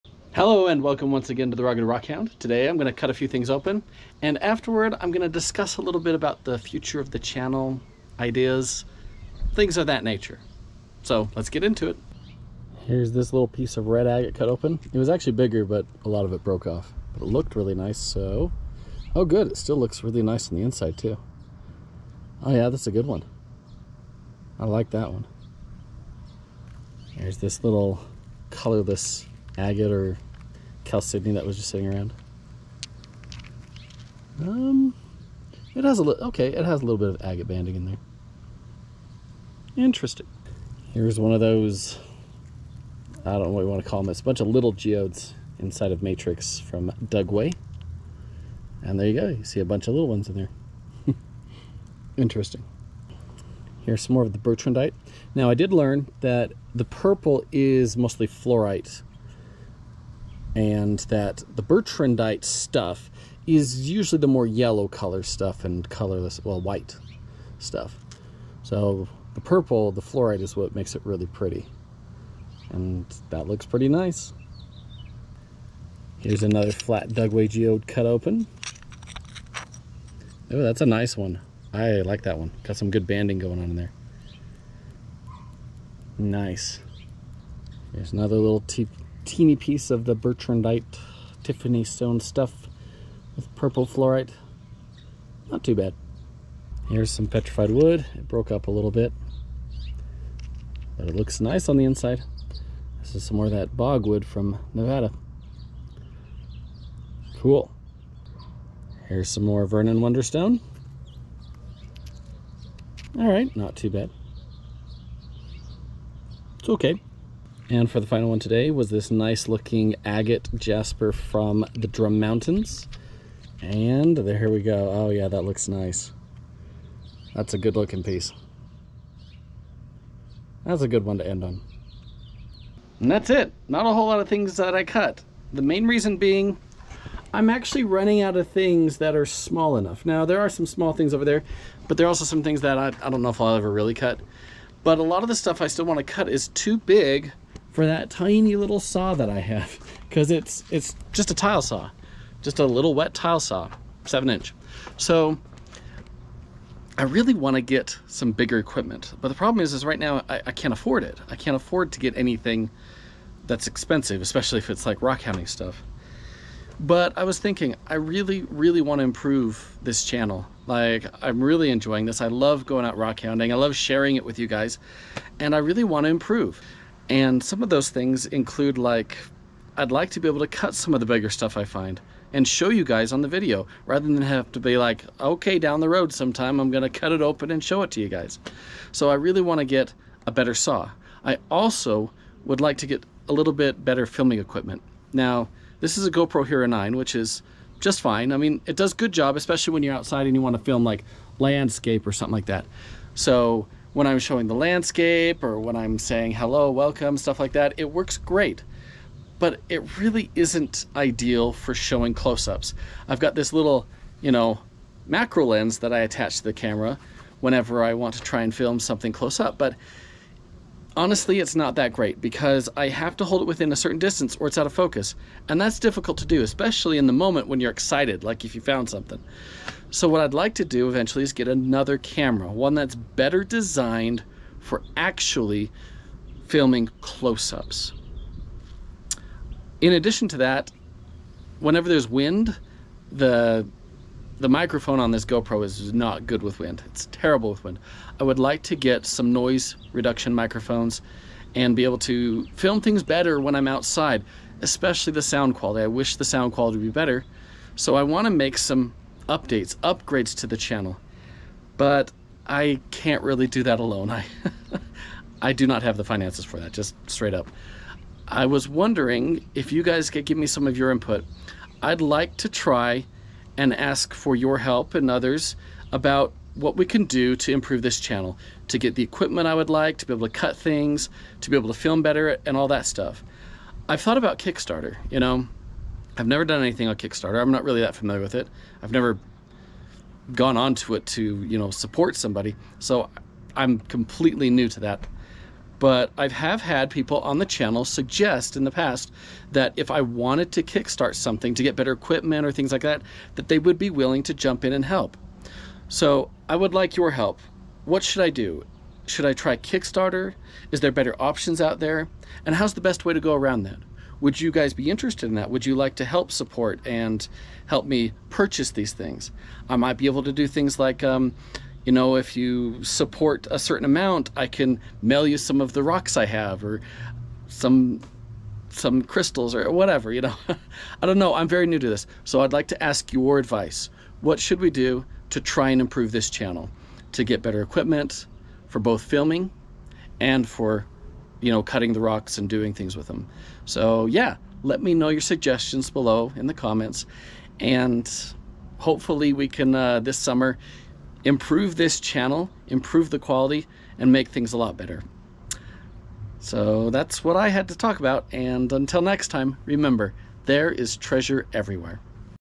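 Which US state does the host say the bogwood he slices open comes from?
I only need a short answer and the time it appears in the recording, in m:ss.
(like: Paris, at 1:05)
Nevada, at 1:44.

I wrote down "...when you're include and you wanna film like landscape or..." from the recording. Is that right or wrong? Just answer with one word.
wrong.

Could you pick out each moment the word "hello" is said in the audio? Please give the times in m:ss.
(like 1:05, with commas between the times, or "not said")
0:00, 3:26.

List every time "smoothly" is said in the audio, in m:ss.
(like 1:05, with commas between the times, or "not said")
not said.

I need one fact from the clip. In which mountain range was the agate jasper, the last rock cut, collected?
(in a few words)
Drum Mountains.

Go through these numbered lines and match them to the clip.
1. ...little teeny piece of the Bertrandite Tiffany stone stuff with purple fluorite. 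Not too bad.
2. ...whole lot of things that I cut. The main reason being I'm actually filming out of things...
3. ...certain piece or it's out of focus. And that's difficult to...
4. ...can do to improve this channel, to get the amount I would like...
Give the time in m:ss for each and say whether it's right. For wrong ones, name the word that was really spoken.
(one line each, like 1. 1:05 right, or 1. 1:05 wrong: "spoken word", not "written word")
1. 1:28 right
2. 2:13 wrong: "running", not "filming"
3. 3:43 wrong: "distance", not "piece"
4. 4:36 wrong: "equipment", not "amount".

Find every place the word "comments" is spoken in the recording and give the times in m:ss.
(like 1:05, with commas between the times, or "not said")
5:46.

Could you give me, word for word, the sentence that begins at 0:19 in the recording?
Oh good, it still looks really nice on the inside too.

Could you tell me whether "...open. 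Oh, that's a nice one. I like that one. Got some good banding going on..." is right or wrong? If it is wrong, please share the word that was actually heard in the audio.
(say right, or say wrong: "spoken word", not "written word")
right.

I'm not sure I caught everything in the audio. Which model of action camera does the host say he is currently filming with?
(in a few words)
GoPro Hero 9.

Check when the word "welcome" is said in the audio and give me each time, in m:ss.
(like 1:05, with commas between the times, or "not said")
0:00, 3:26.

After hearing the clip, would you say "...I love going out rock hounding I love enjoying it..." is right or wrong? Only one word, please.
wrong.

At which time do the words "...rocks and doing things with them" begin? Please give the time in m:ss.
5:41.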